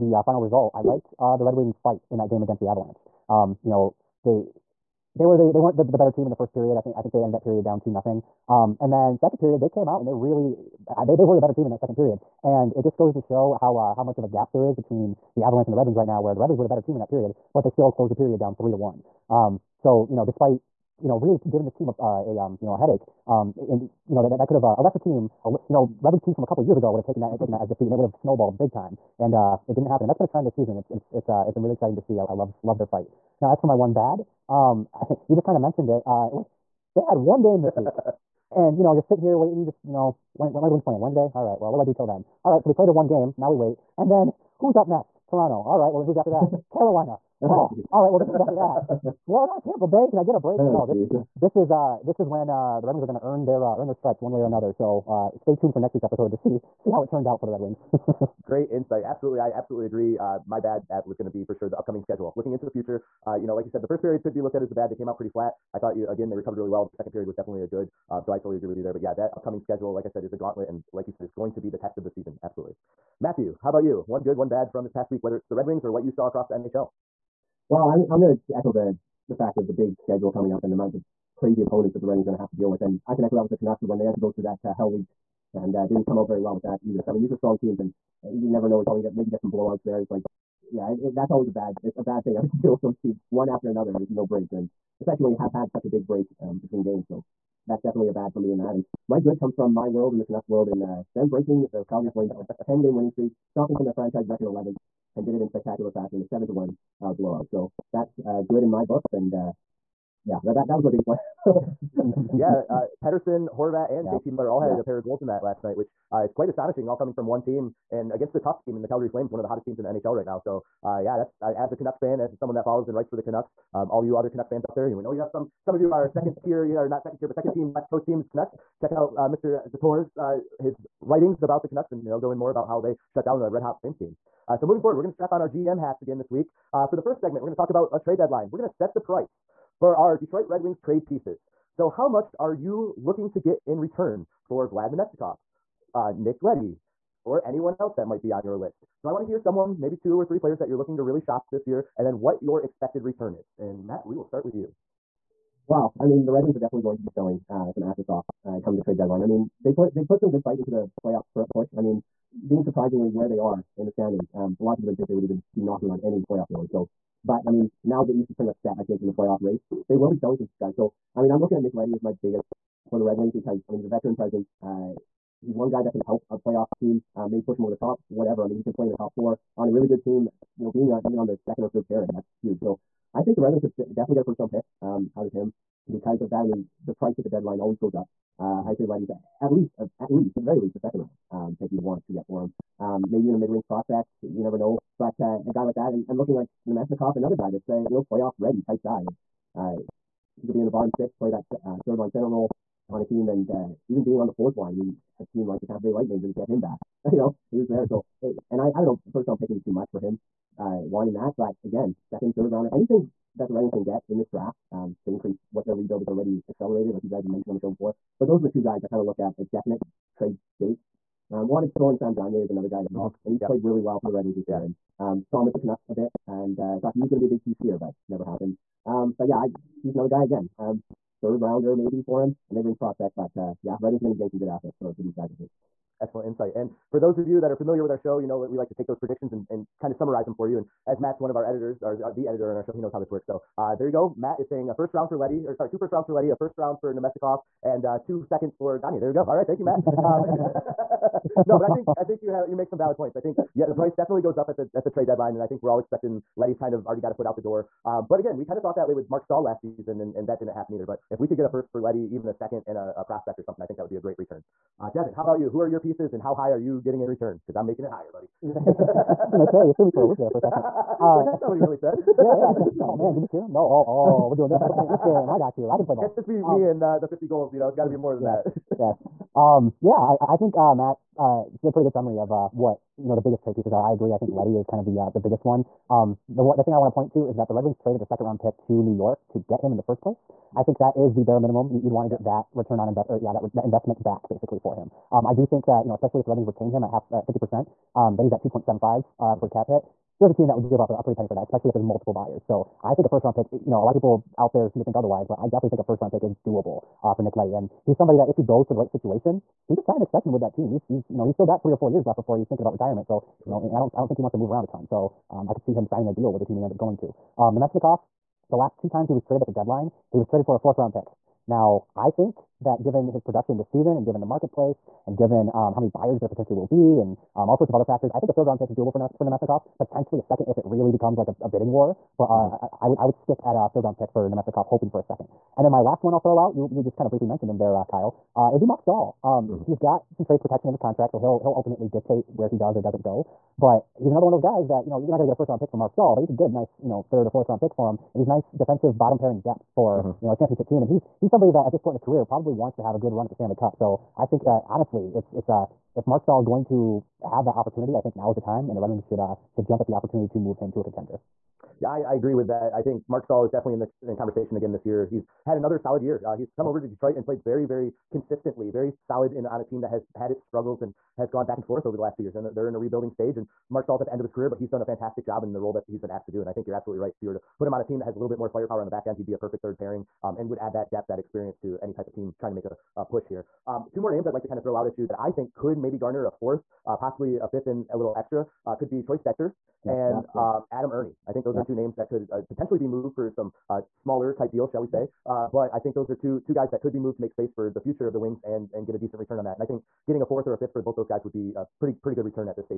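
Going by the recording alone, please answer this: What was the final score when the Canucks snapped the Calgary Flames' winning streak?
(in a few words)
7 to 1.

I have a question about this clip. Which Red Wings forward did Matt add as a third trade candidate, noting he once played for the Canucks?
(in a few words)
Sam Gagner.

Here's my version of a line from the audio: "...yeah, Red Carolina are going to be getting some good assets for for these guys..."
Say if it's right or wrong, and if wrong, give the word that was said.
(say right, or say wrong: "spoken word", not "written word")
wrong: "Wings", not "Carolina".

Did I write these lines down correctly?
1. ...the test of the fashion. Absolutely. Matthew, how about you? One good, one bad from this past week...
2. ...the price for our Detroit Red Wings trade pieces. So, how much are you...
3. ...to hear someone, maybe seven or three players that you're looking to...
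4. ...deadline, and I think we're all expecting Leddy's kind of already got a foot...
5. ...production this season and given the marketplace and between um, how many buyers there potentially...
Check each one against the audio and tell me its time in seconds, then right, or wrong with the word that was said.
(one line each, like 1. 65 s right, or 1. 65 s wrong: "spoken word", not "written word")
1. 71 s wrong: "season", not "fashion"
2. 138 s right
3. 149 s wrong: "two", not "seven"
4. 255 s right
5. 323 s wrong: "given", not "between".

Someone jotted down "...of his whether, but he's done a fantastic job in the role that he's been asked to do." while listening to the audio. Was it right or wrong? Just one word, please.
wrong.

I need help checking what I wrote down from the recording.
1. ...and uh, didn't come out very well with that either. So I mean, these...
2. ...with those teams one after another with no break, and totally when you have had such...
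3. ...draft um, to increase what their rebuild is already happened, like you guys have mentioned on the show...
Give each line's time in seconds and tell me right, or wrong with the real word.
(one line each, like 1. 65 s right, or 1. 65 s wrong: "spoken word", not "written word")
1. 85 s right
2. 92 s wrong: "especially", not "totally"
3. 214 s wrong: "accelerated", not "happened".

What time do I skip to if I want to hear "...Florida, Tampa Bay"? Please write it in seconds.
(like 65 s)
49 s.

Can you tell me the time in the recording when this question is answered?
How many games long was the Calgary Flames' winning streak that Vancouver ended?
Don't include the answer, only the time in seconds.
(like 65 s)
102 s.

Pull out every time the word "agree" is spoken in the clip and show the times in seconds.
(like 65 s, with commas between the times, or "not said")
59 s, 68 s, 283 s, 362 s.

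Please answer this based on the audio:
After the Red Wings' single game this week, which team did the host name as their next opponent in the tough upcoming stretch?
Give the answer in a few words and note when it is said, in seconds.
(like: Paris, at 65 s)
Toronto, at 45 s.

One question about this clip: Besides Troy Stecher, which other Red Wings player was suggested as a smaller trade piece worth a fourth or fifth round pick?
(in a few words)
Adam Erne.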